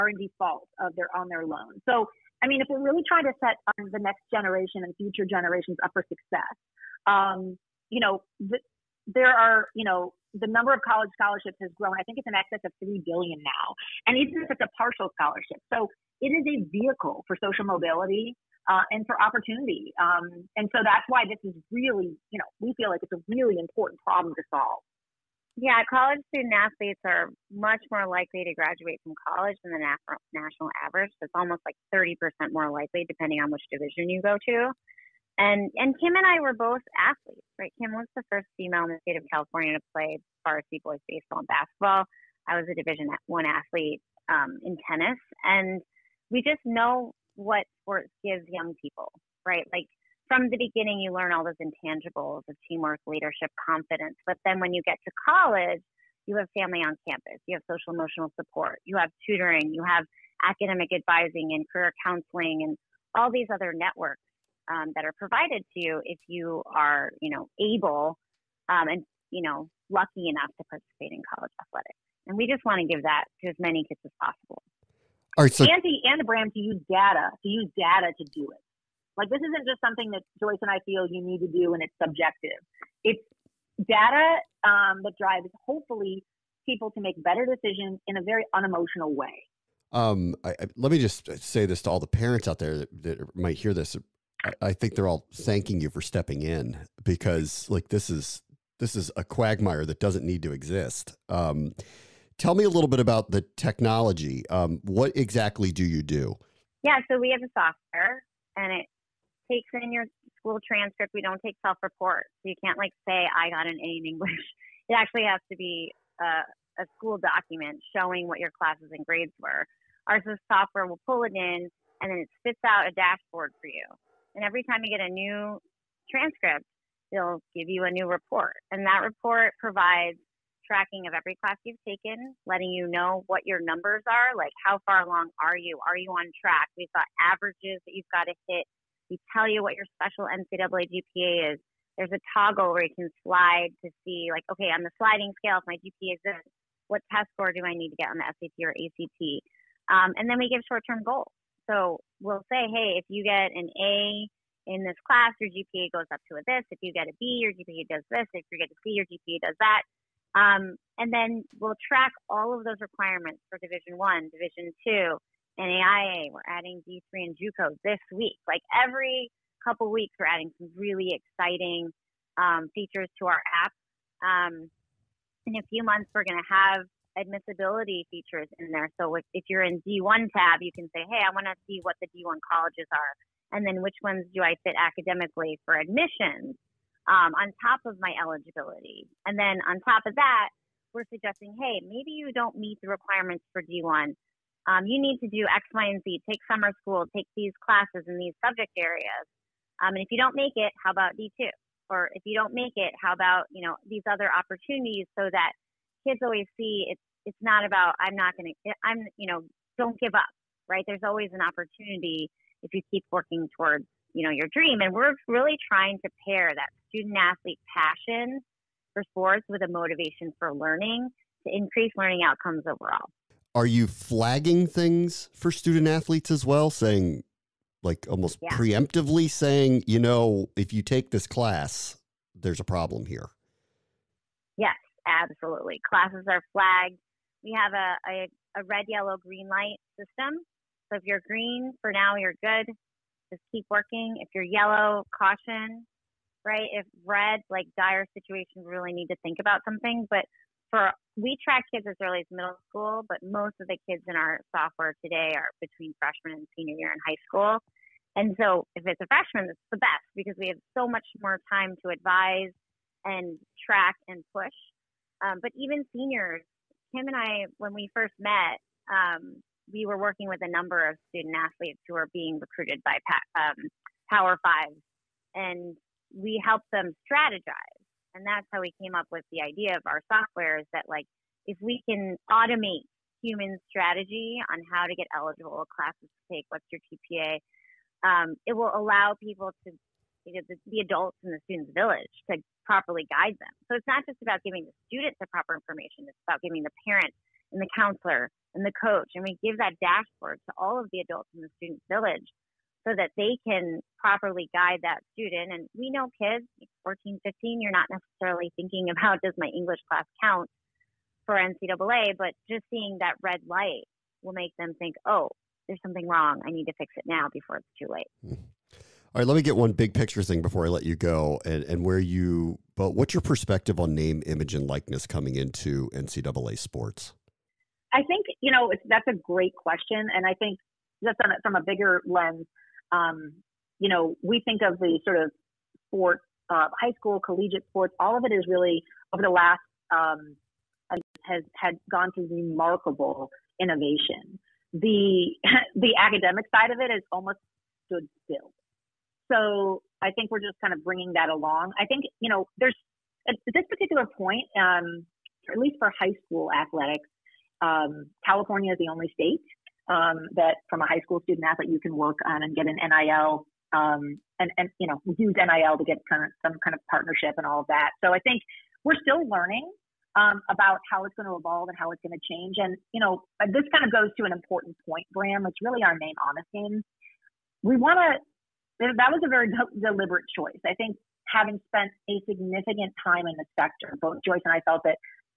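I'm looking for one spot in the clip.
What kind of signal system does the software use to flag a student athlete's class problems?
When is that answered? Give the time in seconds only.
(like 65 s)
238 s.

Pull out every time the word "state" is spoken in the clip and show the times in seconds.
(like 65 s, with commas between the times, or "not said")
39 s, 359 s.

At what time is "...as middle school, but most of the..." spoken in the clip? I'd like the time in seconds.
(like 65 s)
252 s.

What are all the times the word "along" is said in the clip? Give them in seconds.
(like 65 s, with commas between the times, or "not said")
135 s, 351 s.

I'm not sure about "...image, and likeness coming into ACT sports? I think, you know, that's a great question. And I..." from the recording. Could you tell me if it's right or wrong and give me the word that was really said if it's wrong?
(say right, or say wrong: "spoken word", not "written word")
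wrong: "NCAA", not "ACT".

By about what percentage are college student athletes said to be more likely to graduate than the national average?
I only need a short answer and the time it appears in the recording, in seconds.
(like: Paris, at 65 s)
30%, at 31 s.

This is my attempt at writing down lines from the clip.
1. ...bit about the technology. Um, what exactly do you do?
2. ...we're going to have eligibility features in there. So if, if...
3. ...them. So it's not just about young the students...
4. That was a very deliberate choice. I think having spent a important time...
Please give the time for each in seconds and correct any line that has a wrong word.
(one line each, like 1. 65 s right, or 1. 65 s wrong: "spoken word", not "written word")
1. 102 s right
2. 176 s wrong: "admissibility", not "eligibility"
3. 293 s wrong: "giving", not "young"
4. 378 s wrong: "significant", not "important".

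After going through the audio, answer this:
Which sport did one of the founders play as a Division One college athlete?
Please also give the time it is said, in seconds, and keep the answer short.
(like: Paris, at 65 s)
Tennis, at 44 s.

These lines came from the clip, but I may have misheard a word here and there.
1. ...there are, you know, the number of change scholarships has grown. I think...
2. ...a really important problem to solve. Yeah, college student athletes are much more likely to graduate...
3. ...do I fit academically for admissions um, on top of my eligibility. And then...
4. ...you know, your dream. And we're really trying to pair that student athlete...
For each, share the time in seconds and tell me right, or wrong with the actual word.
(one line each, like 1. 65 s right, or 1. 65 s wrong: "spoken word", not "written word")
1. 9 s wrong: "college", not "change"
2. 23 s right
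3. 184 s right
4. 214 s right.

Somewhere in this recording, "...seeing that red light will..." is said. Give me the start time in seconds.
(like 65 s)
312 s.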